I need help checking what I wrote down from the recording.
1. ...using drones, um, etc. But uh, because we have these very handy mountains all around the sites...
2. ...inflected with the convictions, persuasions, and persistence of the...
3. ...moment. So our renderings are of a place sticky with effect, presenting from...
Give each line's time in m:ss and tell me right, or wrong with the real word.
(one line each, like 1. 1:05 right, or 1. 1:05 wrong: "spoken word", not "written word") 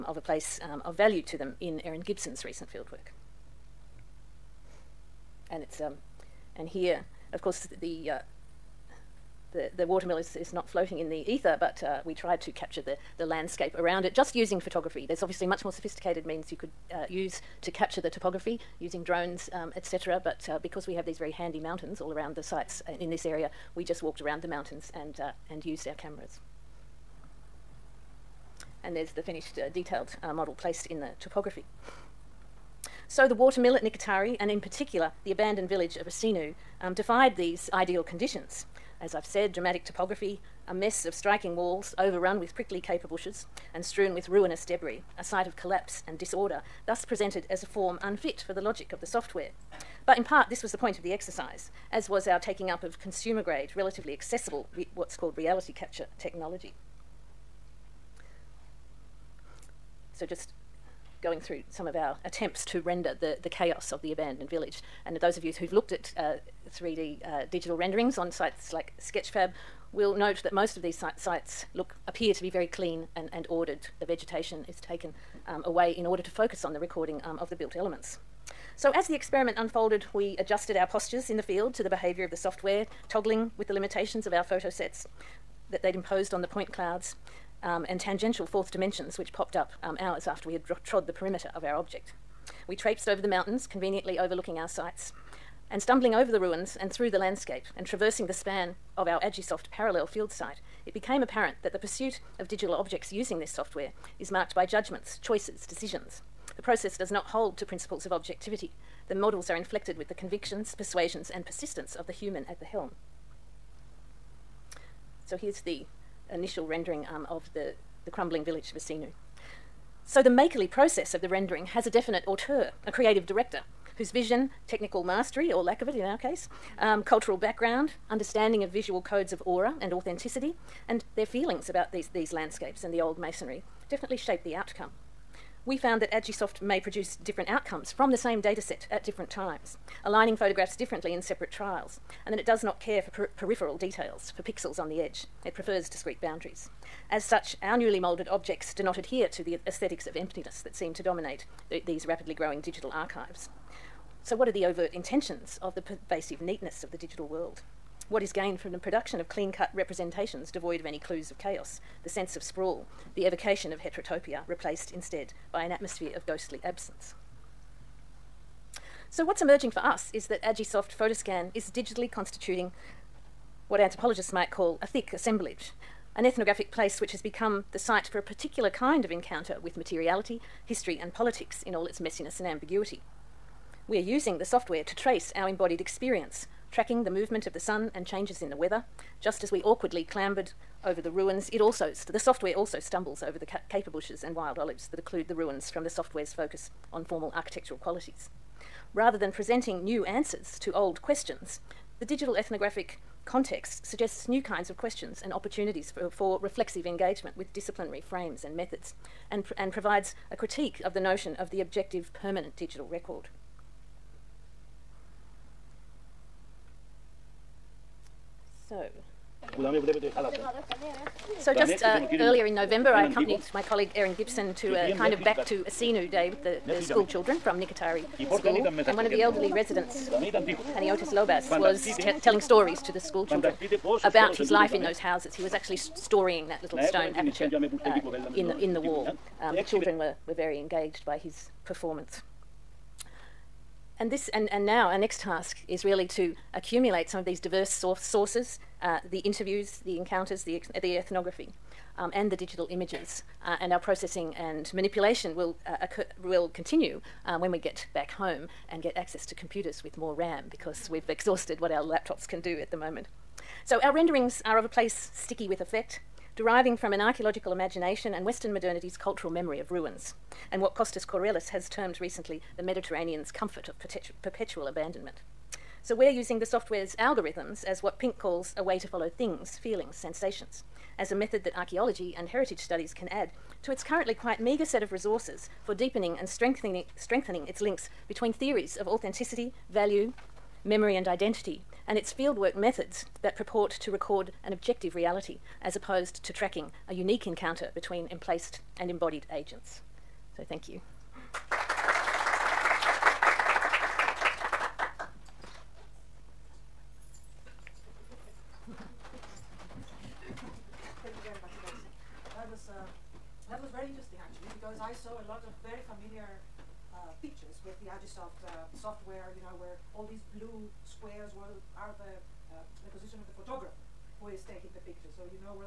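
1. 0:18 right
2. 1:49 right
3. 4:22 wrong: "deriving", not "presenting".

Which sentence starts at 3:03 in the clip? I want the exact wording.
We are using the software to trace our embodied experience, tracking the movement of the sun and changes in the weather.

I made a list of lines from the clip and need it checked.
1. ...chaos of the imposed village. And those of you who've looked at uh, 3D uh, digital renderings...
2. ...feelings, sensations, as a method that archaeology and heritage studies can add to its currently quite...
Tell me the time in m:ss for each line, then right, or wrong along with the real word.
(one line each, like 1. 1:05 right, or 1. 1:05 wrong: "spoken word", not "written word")
1. 1:03 wrong: "abandoned", not "imposed"
2. 4:39 right.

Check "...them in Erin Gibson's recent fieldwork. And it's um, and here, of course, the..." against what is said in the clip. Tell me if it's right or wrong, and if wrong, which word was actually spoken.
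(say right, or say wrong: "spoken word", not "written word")
right.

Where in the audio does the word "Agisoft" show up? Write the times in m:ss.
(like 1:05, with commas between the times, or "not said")
1:39, 2:16, 2:50.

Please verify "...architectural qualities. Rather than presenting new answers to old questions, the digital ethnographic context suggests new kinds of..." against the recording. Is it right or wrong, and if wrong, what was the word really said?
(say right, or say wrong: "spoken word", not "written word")
right.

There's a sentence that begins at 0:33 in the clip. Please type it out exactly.
So the water mill at Nikitari, and in particular the abandoned village of Asinou, um, defied these ideal conditions.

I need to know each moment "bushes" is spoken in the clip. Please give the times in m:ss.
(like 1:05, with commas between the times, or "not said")
0:43, 3:13.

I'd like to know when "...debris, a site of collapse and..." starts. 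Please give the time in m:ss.
0:44.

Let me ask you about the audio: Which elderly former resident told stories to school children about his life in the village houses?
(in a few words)
Paniotis Lobas.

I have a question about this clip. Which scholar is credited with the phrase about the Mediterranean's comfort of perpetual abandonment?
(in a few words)
Kostis Kourelis.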